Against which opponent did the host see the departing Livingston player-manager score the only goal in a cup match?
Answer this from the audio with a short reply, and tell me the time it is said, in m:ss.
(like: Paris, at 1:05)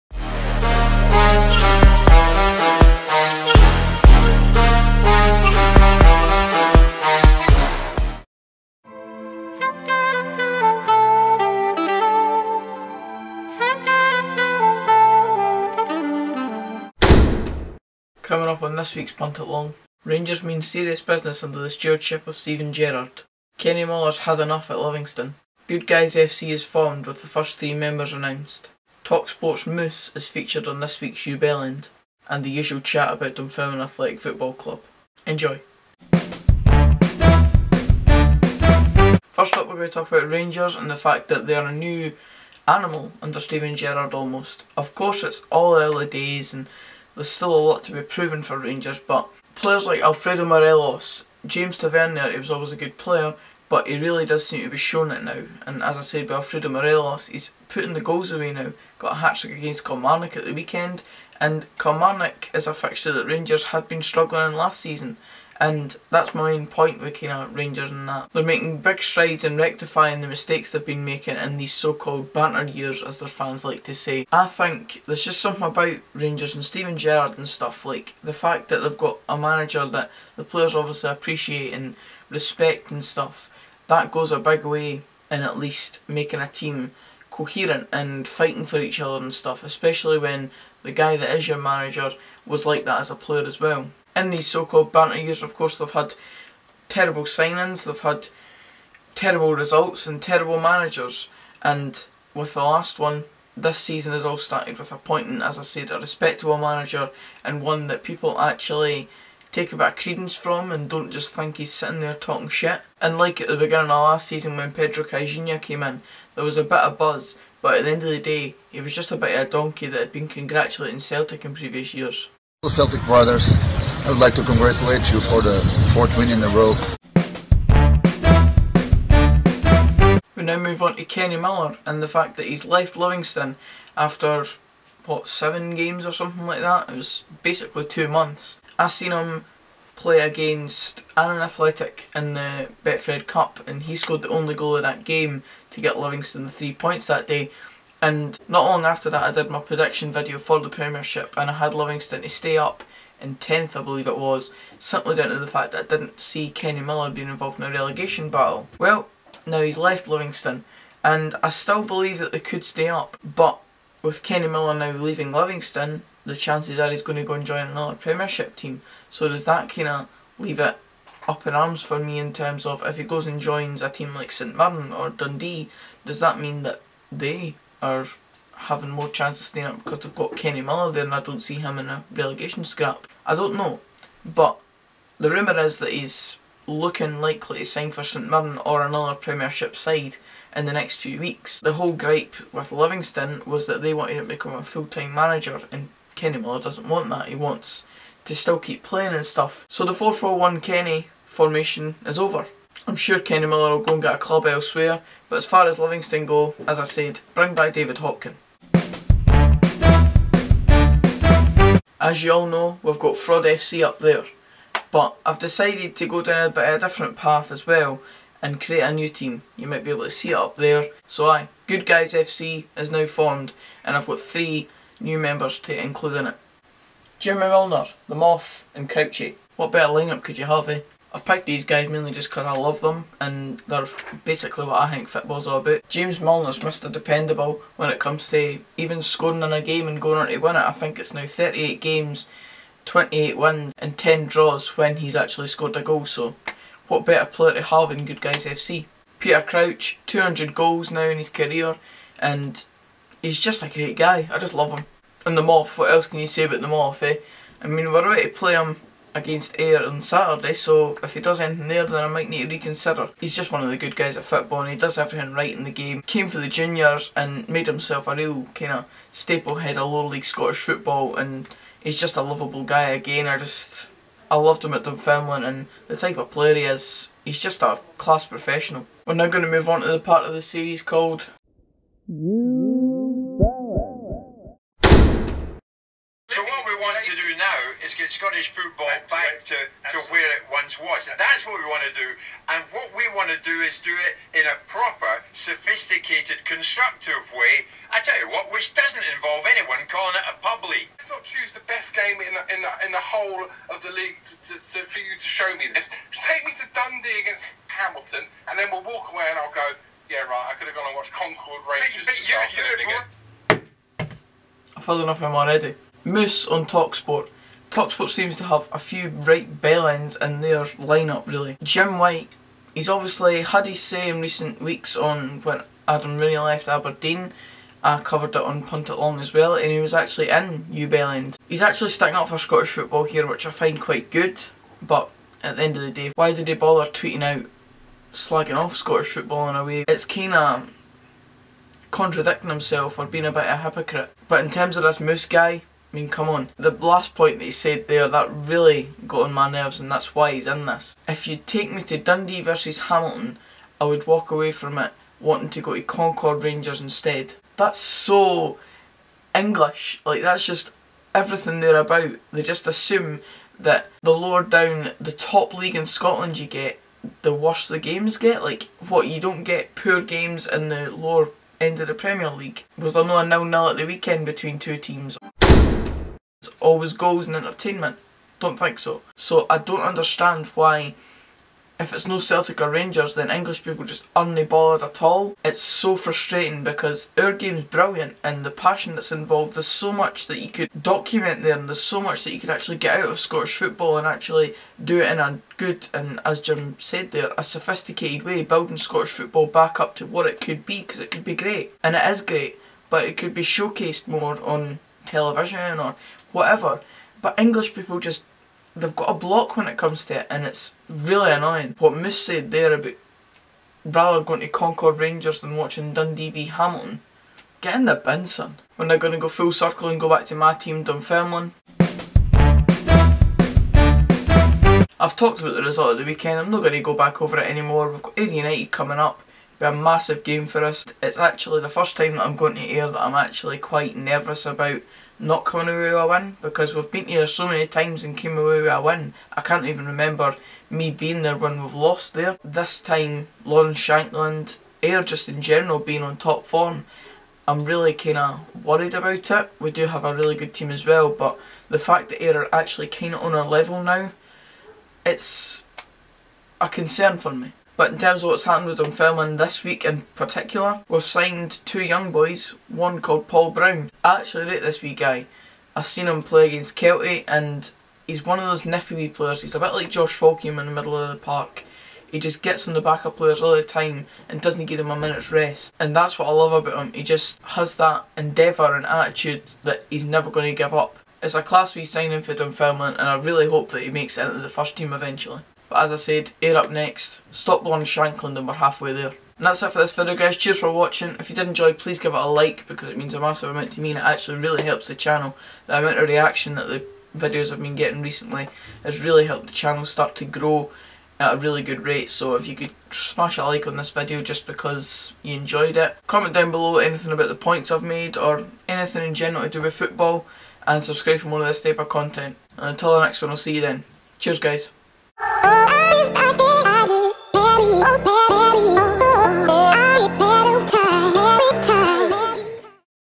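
Annan Athletic, at 2:21.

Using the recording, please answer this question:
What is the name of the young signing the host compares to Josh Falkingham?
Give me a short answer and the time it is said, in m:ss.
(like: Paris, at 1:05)
Paul Brown, at 7:43.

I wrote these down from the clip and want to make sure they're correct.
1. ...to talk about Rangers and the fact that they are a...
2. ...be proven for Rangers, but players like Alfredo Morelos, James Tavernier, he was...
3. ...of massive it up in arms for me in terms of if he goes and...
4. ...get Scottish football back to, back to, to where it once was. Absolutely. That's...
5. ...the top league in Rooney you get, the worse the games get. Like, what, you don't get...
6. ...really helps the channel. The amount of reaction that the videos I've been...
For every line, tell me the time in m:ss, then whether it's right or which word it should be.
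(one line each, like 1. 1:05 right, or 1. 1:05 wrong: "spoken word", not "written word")
1. 0:39 right
2. 0:47 right
3. 2:49 wrong: "leave", not "massive"
4. 4:47 right
5. 6:05 wrong: "Scotland", not "Rooney"
6. 8:14 right.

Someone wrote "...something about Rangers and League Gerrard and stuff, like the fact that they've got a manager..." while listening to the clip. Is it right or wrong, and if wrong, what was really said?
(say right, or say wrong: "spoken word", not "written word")
wrong: "Steven", not "League".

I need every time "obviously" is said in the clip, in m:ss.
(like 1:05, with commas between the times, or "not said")
1:20, 5:22.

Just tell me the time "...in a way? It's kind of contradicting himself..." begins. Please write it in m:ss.
5:39.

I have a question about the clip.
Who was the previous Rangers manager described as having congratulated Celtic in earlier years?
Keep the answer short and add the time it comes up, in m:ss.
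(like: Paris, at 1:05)
Pedro Caixinha, at 1:54.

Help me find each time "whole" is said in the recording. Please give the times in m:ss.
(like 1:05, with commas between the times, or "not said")
3:11, 5:03.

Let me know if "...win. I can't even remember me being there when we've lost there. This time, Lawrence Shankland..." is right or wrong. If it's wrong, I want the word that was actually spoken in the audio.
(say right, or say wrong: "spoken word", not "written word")
right.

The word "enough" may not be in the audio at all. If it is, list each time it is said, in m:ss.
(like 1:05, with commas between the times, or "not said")
0:24, 5:15.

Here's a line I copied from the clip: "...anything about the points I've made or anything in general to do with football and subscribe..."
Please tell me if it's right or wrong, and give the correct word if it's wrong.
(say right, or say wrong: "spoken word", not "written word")
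right.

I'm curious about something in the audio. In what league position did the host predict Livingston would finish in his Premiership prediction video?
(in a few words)
10th.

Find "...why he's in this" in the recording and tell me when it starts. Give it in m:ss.
5:50.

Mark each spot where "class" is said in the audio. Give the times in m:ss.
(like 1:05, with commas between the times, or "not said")
4:37, 8:01.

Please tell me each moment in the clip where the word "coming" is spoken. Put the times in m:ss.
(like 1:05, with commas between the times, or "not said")
0:18, 7:08.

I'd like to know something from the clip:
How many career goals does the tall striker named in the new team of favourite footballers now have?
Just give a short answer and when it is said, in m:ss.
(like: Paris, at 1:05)
200, at 4:10.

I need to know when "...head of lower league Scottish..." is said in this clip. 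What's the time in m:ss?
4:29.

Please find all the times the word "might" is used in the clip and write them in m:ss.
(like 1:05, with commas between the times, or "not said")
3:39, 4:22.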